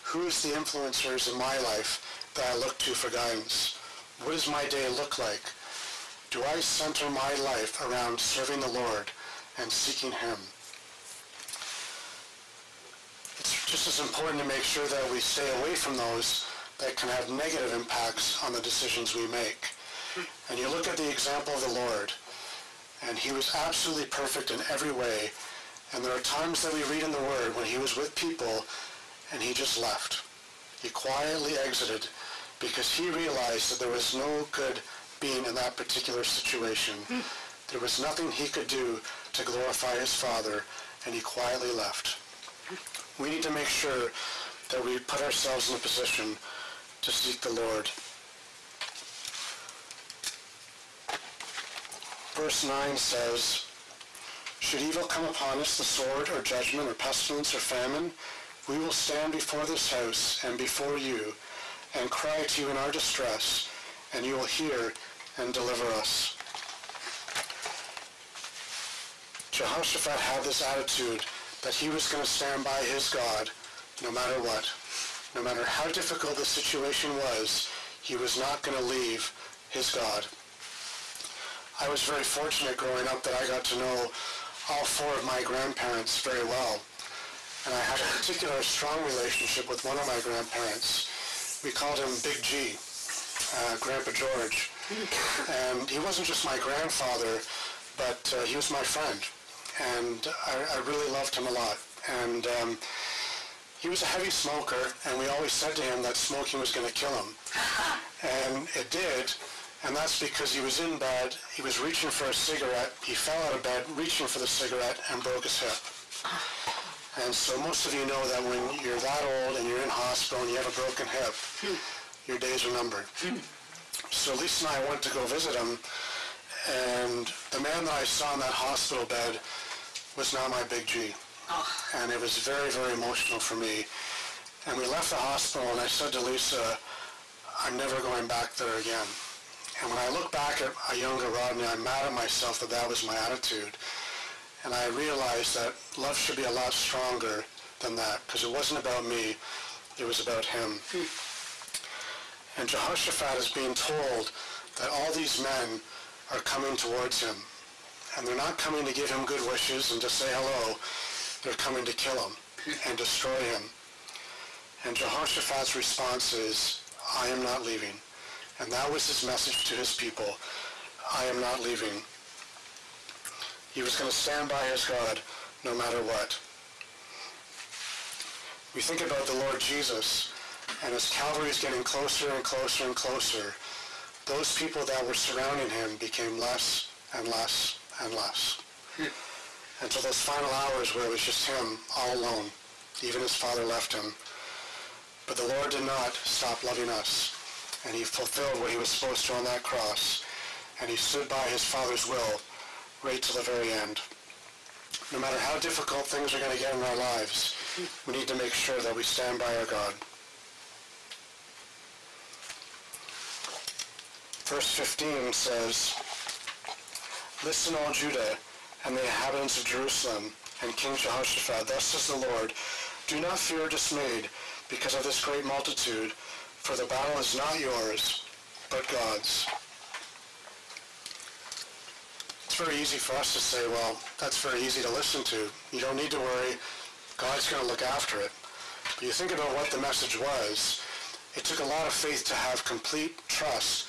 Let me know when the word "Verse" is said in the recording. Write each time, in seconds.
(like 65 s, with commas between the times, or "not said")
52 s, 214 s.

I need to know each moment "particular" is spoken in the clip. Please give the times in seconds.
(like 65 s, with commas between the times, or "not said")
35 s, 88 s.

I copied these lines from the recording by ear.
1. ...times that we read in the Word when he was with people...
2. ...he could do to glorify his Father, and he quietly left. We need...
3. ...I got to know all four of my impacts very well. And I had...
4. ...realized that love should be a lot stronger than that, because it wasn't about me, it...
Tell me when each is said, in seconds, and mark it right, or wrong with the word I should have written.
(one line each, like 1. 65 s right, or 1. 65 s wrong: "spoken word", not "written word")
1. 26 s right
2. 38 s right
3. 83 s wrong: "grandparents", not "impacts"
4. 144 s right.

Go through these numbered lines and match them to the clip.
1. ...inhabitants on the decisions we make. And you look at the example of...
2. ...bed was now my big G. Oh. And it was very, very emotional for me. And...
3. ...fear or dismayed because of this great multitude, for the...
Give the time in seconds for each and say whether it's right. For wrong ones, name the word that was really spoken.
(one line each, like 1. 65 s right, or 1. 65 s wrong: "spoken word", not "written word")
1. 17 s wrong: "impacts", not "inhabitants"
2. 129 s right
3. 223 s right.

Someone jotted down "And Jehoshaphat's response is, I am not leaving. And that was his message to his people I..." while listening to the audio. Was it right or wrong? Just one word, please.
right.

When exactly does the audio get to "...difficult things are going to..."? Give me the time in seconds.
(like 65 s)
205 s.